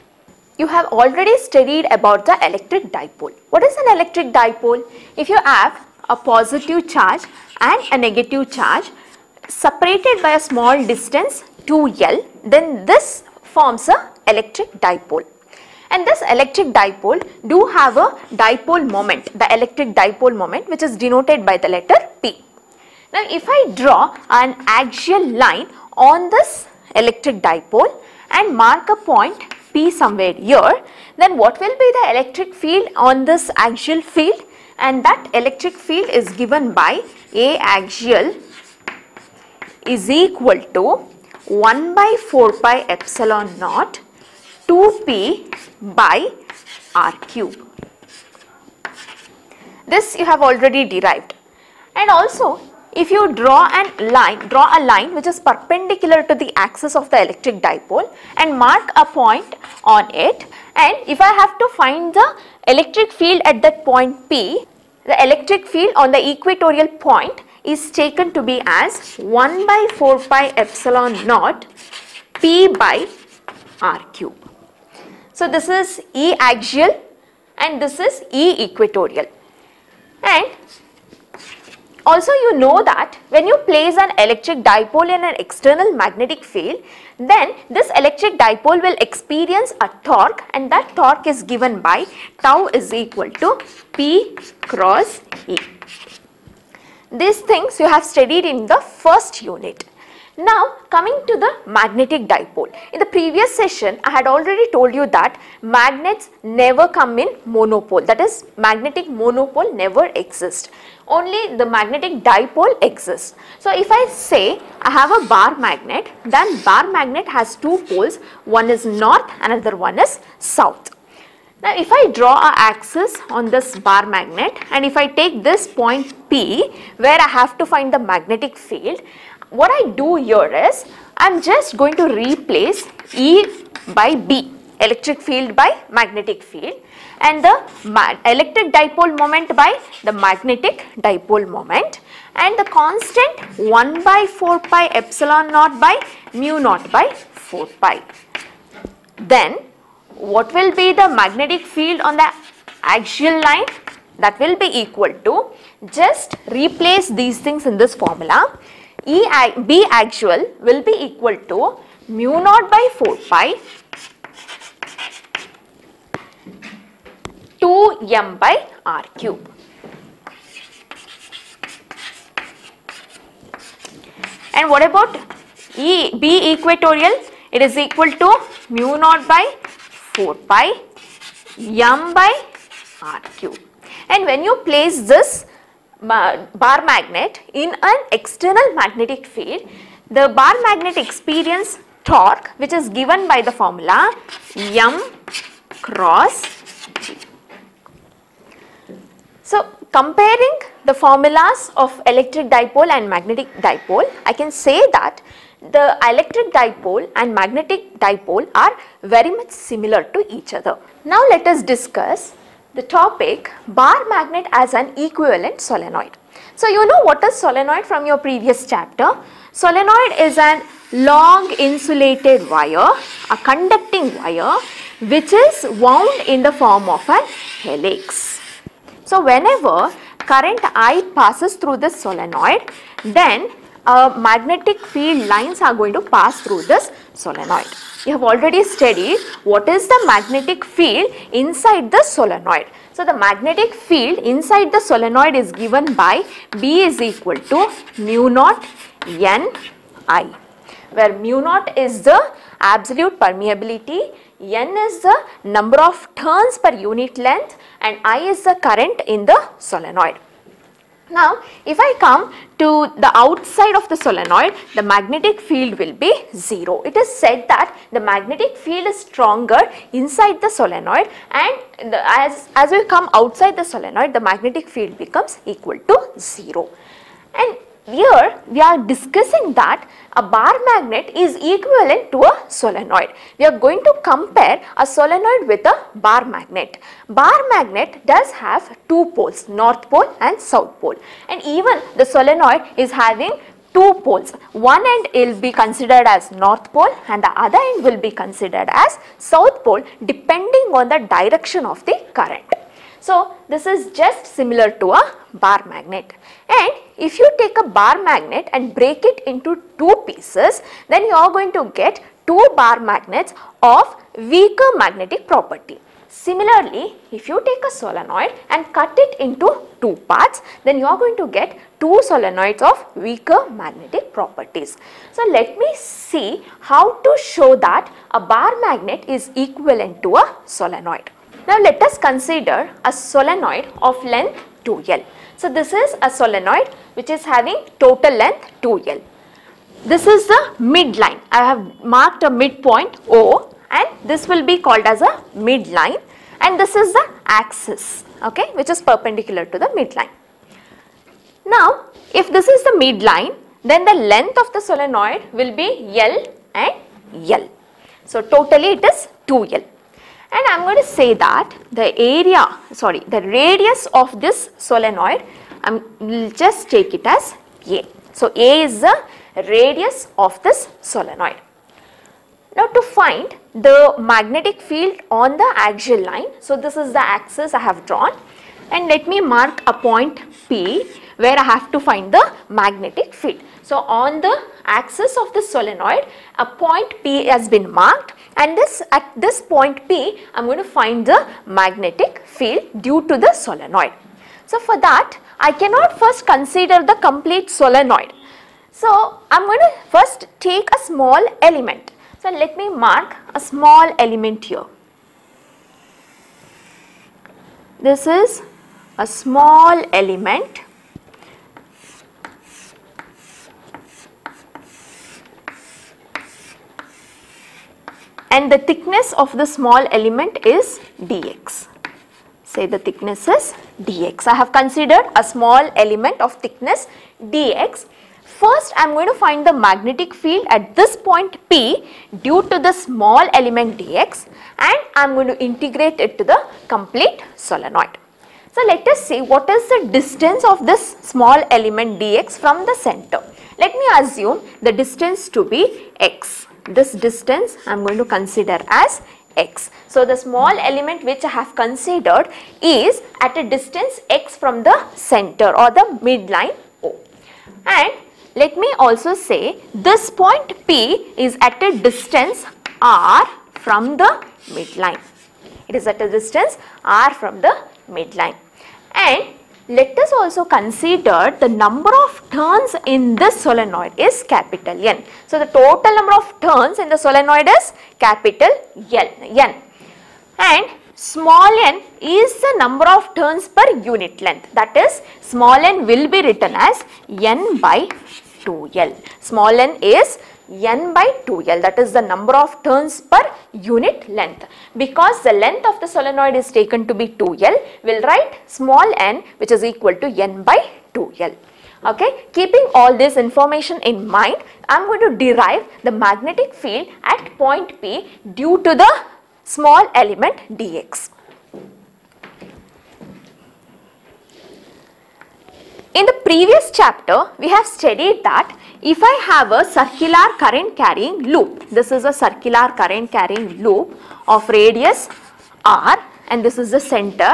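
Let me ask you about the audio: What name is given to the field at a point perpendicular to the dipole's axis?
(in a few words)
E equatorial.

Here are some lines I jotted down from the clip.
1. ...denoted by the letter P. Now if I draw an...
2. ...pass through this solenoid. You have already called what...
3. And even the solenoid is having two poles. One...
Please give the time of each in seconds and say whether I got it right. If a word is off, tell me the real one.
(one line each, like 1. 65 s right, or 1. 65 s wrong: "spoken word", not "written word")
1. 21 s right
2. 236 s wrong: "studied", not "called"
3. 291 s right.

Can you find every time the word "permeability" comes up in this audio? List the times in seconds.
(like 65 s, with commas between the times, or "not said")
253 s.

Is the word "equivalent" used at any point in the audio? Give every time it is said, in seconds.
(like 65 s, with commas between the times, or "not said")
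214 s, 281 s, 329 s.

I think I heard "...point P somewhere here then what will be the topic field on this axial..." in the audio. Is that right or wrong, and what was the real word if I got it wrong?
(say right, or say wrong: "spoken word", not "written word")
wrong: "electric", not "topic".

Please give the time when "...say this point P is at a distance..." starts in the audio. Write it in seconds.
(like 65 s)
459 s.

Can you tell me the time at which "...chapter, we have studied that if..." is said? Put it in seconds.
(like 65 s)
516 s.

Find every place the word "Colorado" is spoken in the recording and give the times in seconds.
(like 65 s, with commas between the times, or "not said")
not said.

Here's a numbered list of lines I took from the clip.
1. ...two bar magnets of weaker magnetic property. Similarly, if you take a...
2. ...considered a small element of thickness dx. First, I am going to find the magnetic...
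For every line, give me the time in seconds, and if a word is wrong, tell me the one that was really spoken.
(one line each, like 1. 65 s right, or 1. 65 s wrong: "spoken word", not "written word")
1. 312 s right
2. 424 s right.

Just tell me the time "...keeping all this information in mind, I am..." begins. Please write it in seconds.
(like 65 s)
502 s.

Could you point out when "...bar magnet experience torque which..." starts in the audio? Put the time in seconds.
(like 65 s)
190 s.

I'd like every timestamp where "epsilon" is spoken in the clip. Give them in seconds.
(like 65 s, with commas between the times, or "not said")
42 s, 70 s, 145 s.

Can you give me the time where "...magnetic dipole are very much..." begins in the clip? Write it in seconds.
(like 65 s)
207 s.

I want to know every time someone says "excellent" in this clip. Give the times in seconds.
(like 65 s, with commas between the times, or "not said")
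not said.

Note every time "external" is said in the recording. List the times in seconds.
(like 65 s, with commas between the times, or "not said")
85 s, 188 s.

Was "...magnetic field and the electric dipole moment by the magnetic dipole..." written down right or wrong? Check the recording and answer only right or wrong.
right.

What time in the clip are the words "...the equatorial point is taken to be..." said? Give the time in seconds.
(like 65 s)
66 s.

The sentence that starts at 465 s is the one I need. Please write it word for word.
It is at a distance r from the midline.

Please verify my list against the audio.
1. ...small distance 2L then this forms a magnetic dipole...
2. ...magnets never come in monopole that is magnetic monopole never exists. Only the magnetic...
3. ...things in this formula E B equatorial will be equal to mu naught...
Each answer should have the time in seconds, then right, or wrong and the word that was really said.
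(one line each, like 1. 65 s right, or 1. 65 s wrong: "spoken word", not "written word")
1. 10 s wrong: "electric", not "magnetic"
2. 105 s right
3. 157 s wrong: "axial", not "equatorial".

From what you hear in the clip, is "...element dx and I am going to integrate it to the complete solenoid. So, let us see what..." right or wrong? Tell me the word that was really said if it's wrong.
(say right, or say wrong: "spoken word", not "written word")
right.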